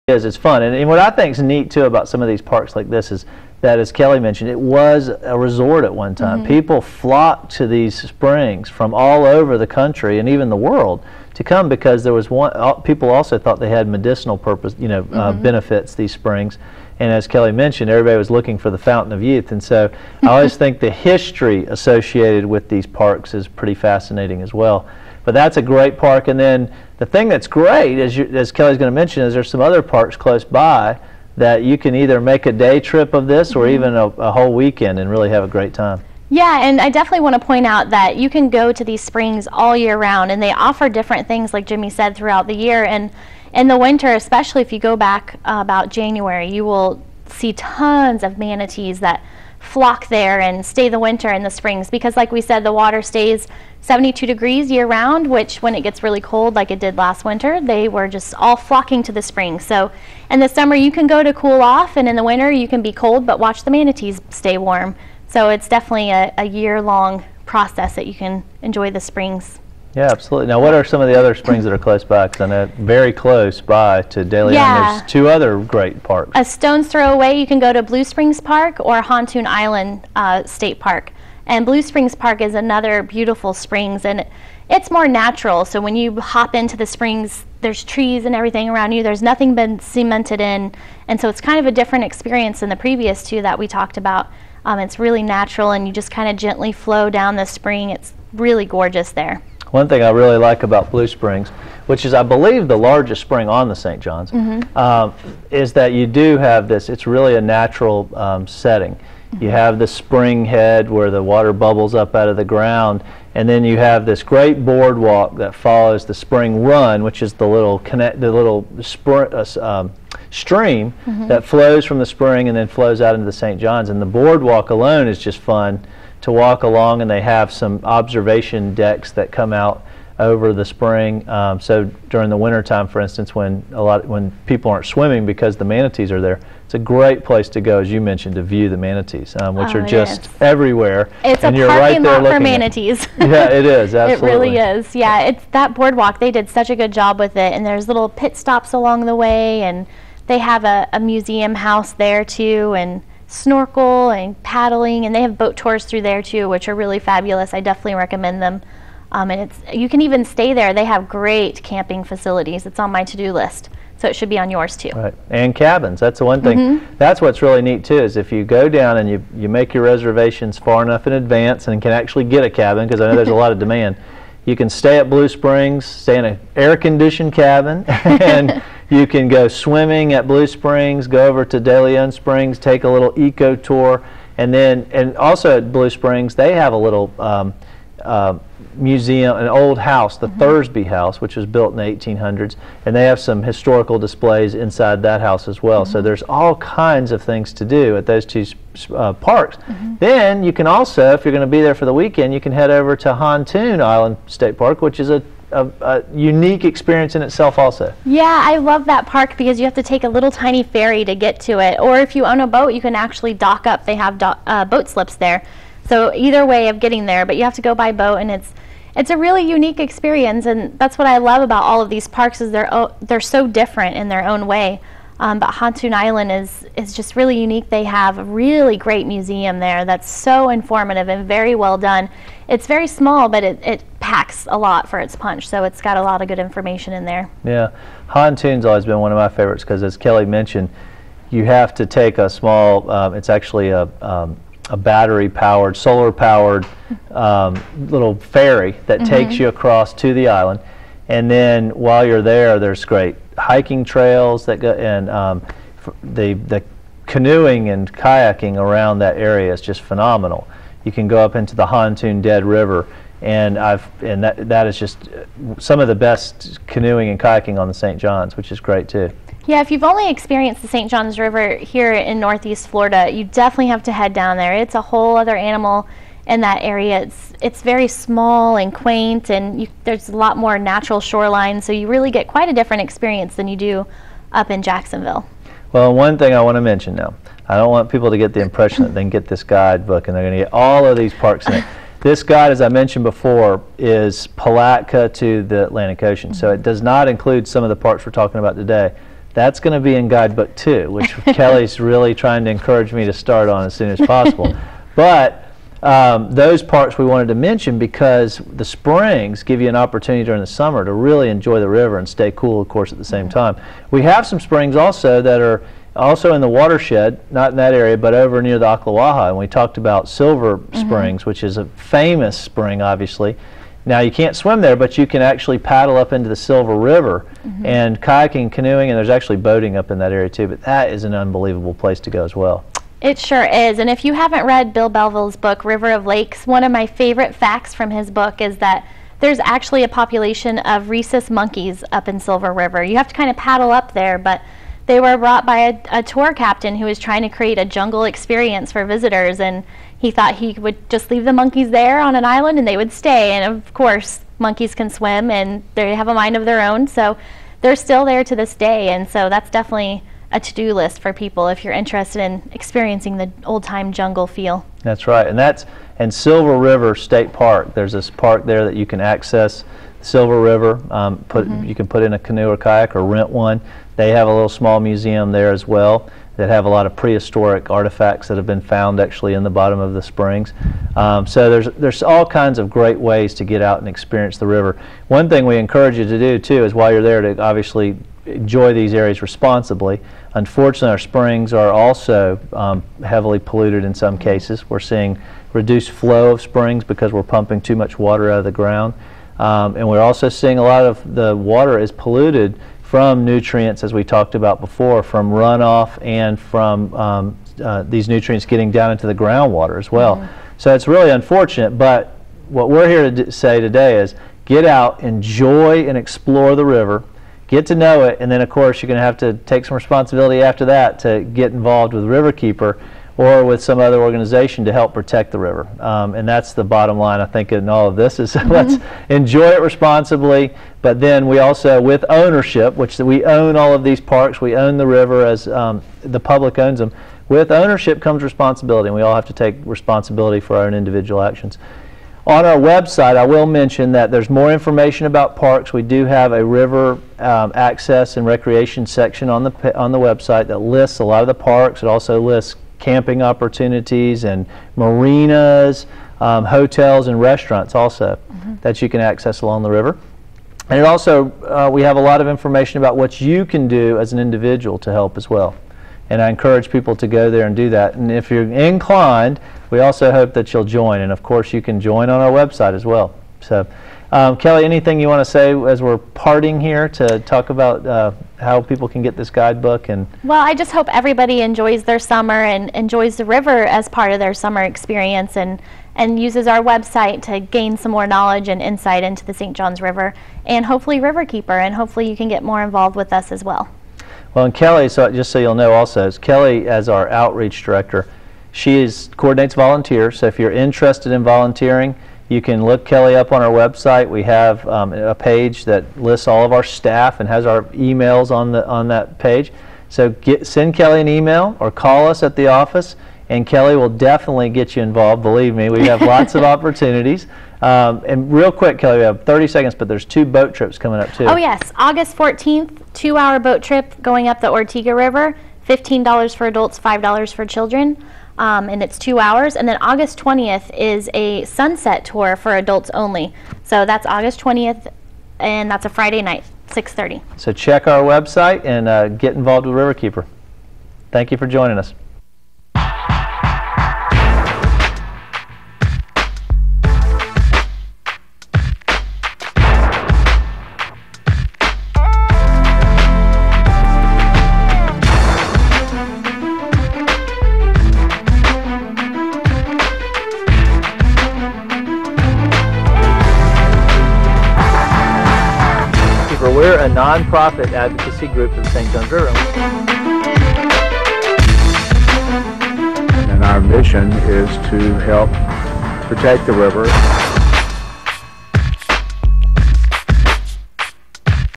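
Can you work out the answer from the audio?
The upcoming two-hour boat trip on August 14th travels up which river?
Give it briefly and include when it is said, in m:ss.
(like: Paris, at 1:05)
Ortega River, at 8:44.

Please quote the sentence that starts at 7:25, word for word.
We do have a river um, access and recreation section on the, on the website that lists a lot of the parks.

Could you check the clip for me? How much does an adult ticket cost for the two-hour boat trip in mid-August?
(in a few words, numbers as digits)
$15.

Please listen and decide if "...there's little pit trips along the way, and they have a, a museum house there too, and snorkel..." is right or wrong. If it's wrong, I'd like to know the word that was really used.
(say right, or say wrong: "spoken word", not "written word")
wrong: "stops", not "trips".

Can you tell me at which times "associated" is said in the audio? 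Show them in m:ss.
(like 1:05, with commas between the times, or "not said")
0:21.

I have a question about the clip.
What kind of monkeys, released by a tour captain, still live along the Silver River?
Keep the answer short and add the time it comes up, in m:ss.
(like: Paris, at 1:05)
Rhesus monkeys, at 5:40.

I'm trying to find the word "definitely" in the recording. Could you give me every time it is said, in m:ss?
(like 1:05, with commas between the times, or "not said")
0:36, 1:05, 2:37, 4:33, 5:59, 8:33.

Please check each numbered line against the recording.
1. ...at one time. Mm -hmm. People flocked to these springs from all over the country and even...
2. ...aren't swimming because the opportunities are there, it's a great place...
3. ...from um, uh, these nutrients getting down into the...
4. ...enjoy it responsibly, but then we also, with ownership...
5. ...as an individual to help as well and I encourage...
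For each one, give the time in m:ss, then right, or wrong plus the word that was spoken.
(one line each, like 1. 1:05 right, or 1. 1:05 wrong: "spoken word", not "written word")
1. 0:05 right
2. 2:14 wrong: "manatees", not "opportunities"
3. 6:46 right
4. 7:09 right
5. 7:43 right.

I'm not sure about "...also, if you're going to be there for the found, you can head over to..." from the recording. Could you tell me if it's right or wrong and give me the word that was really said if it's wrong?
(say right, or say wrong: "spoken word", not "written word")
wrong: "weekend", not "found".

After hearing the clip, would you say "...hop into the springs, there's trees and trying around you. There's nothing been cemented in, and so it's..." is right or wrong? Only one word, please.
wrong.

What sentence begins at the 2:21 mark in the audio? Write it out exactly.
It's and a you're parking right lot for manatees.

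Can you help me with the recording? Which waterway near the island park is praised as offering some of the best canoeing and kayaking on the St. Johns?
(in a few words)
Hontoon Dead River.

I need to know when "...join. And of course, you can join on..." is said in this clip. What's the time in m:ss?
7:50.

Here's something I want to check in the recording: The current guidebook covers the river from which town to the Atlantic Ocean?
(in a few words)
Palatka.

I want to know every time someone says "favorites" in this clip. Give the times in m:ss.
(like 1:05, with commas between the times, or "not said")
3:59, 5:36.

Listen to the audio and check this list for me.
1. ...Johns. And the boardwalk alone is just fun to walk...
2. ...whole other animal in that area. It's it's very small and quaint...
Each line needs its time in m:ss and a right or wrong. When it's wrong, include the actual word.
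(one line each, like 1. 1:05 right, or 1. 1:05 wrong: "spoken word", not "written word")
1. 2:03 right
2. 4:34 right.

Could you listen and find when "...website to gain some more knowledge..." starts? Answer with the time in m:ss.
8:06.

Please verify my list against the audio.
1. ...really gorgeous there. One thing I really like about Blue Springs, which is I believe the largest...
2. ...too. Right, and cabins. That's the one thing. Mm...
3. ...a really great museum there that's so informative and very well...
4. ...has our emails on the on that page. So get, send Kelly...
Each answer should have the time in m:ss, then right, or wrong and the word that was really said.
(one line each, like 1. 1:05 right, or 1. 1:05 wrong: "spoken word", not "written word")
1. 1:38 right
2. 2:44 right
3. 3:48 right
4. 8:27 right.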